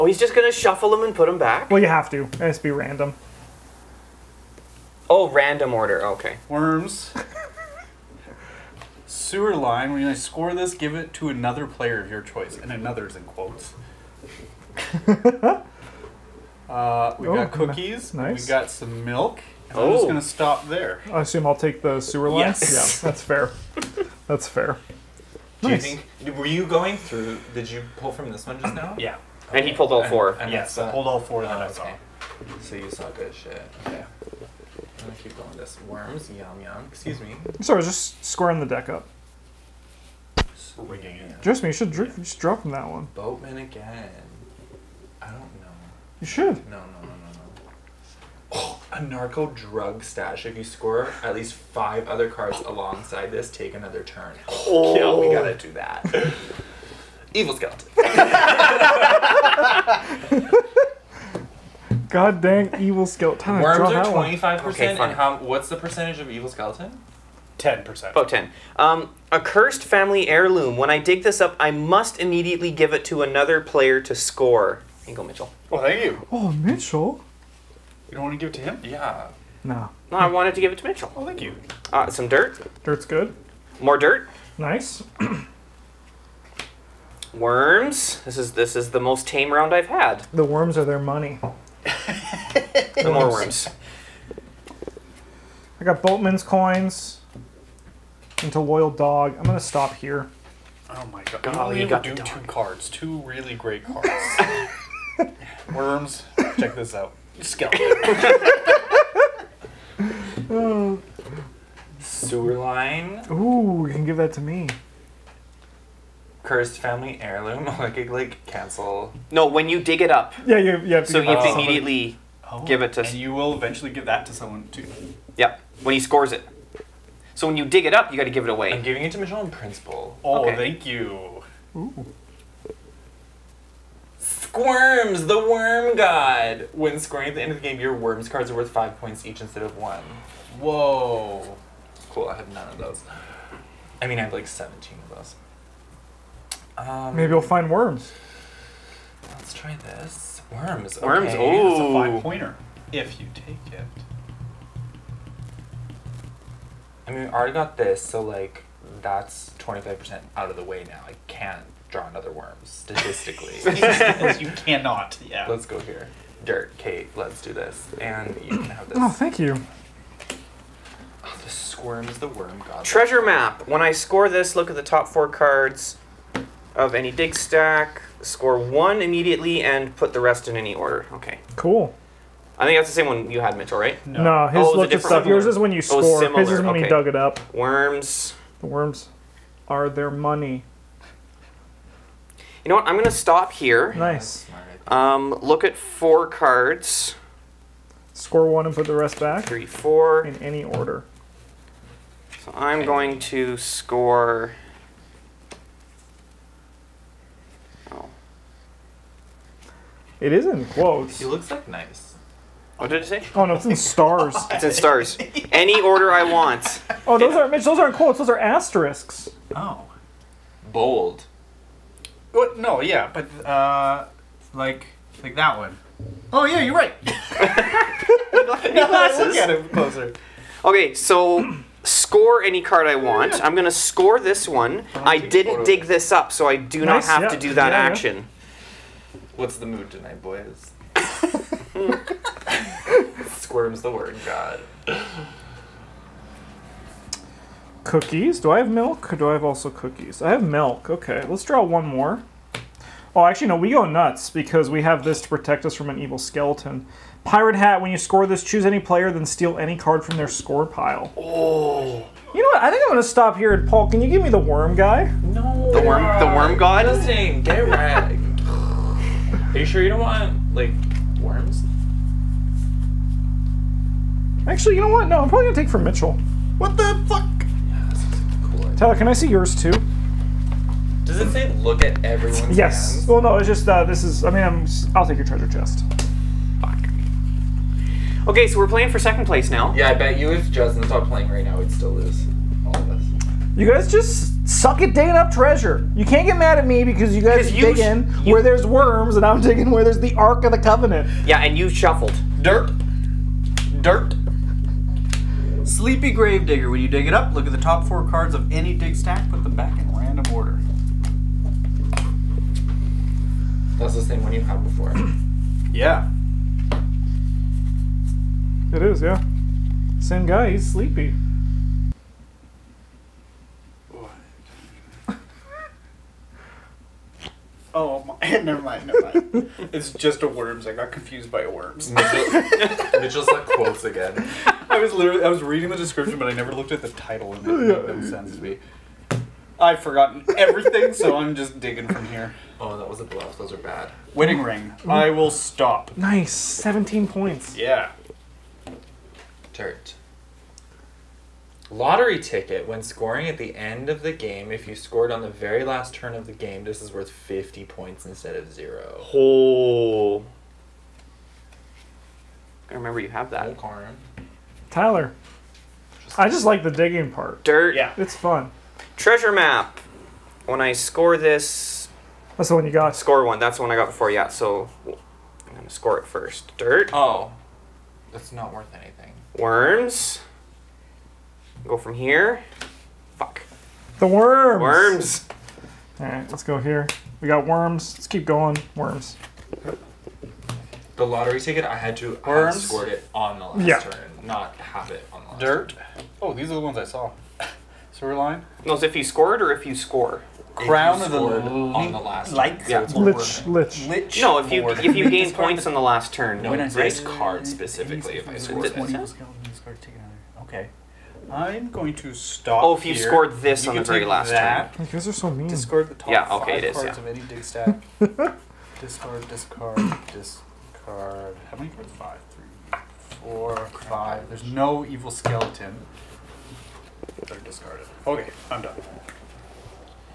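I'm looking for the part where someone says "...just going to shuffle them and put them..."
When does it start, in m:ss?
0:00.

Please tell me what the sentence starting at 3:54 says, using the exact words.
I didn't dig this up, so I do nice, not have yeah.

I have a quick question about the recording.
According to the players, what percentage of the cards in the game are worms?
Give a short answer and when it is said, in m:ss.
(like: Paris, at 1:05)
25%, at 1:04.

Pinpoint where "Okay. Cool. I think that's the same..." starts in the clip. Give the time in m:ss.
3:01.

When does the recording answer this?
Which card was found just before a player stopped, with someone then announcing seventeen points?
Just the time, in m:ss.
5:44.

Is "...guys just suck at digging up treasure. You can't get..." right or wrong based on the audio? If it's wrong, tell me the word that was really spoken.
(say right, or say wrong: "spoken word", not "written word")
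right.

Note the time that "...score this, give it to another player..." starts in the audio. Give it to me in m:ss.
0:10.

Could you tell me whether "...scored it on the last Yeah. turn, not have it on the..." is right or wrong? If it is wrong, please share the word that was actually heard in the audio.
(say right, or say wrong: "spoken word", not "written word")
right.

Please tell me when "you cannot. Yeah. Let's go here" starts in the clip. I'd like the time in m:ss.
2:44.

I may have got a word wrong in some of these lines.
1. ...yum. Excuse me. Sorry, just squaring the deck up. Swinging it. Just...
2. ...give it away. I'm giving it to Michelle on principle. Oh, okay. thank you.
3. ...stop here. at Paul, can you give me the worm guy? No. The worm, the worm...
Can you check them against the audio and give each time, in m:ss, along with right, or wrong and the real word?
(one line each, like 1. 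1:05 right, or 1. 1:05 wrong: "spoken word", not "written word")
1. 0:36 right
2. 2:08 right
3. 4:23 right.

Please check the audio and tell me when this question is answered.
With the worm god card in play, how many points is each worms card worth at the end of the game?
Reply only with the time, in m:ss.
2:18.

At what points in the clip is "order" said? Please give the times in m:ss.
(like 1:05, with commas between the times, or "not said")
0:05, 3:00, 3:20, 3:35, 5:10.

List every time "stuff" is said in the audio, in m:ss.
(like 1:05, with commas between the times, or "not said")
3:05.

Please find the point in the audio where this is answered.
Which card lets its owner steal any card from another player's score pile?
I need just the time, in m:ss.
4:17.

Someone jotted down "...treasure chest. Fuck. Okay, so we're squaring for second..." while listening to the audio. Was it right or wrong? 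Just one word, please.
wrong.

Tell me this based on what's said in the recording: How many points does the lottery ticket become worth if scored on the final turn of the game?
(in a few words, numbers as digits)
50.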